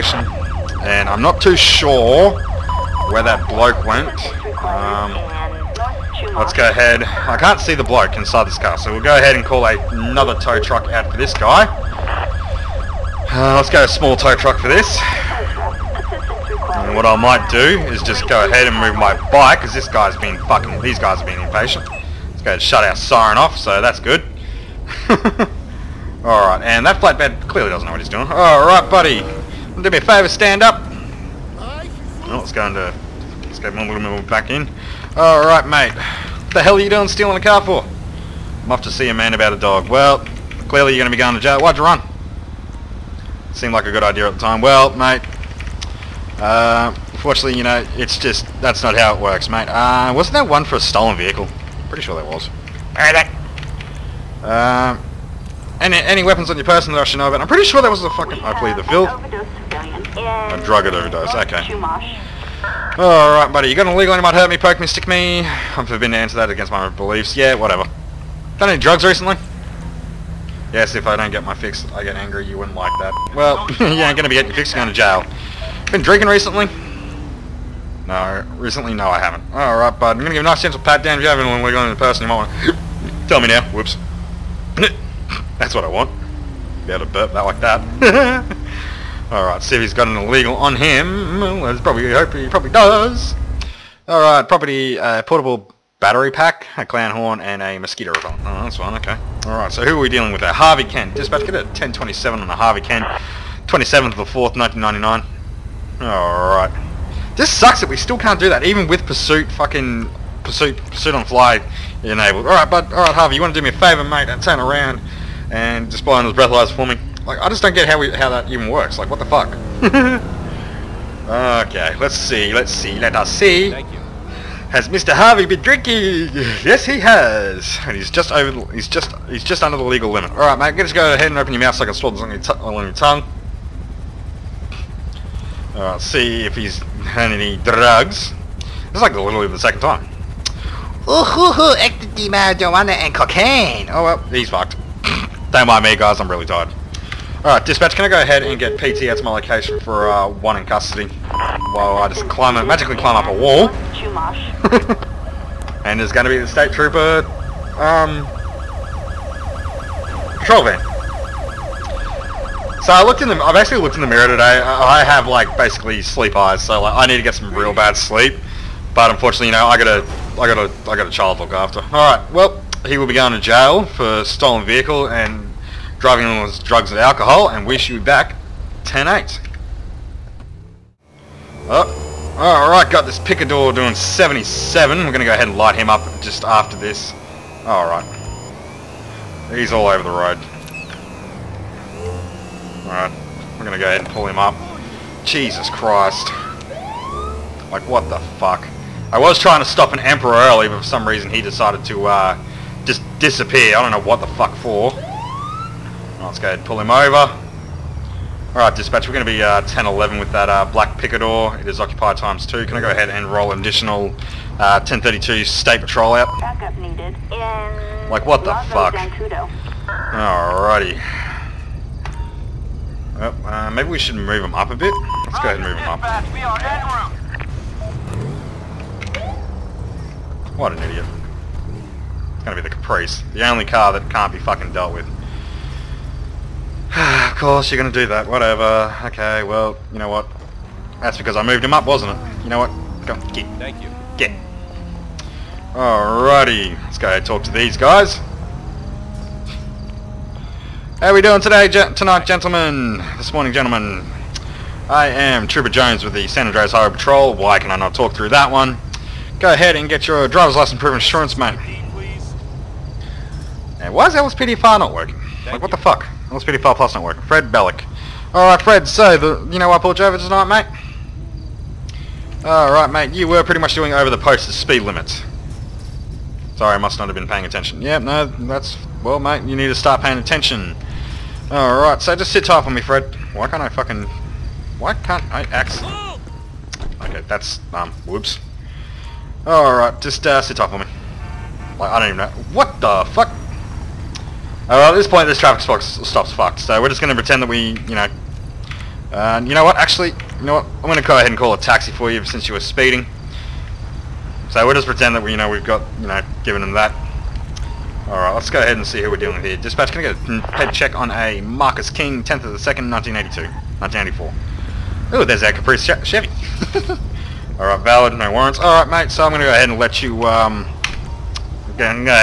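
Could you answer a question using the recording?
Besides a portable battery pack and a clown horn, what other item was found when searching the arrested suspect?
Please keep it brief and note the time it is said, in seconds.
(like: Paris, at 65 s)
Mosquito repellent, at 97 s.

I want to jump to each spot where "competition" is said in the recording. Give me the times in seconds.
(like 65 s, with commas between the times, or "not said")
not said.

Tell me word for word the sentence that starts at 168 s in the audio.
But unfortunately, you know, I got a, I got a, I got a child to look after.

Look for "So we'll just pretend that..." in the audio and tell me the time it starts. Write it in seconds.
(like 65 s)
304 s.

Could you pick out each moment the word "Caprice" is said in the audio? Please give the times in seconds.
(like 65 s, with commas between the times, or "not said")
232 s, 315 s.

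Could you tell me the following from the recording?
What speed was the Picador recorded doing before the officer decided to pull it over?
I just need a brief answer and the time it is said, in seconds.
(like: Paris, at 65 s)
77, at 183 s.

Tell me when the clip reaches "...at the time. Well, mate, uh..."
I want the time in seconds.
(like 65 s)
44 s.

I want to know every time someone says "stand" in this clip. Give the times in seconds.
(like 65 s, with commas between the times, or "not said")
30 s.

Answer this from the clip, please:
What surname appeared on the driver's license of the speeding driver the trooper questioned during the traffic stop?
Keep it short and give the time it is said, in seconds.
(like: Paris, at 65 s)
Bellick, at 267 s.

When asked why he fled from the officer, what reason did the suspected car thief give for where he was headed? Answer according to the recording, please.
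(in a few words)
To see a man about a dog.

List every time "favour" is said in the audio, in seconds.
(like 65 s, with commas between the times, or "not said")
30 s, 113 s.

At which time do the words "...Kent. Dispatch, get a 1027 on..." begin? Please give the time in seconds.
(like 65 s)
100 s.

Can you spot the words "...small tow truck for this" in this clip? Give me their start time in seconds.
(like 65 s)
13 s.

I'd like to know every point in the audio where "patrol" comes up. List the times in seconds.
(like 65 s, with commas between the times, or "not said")
160 s, 215 s, 256 s.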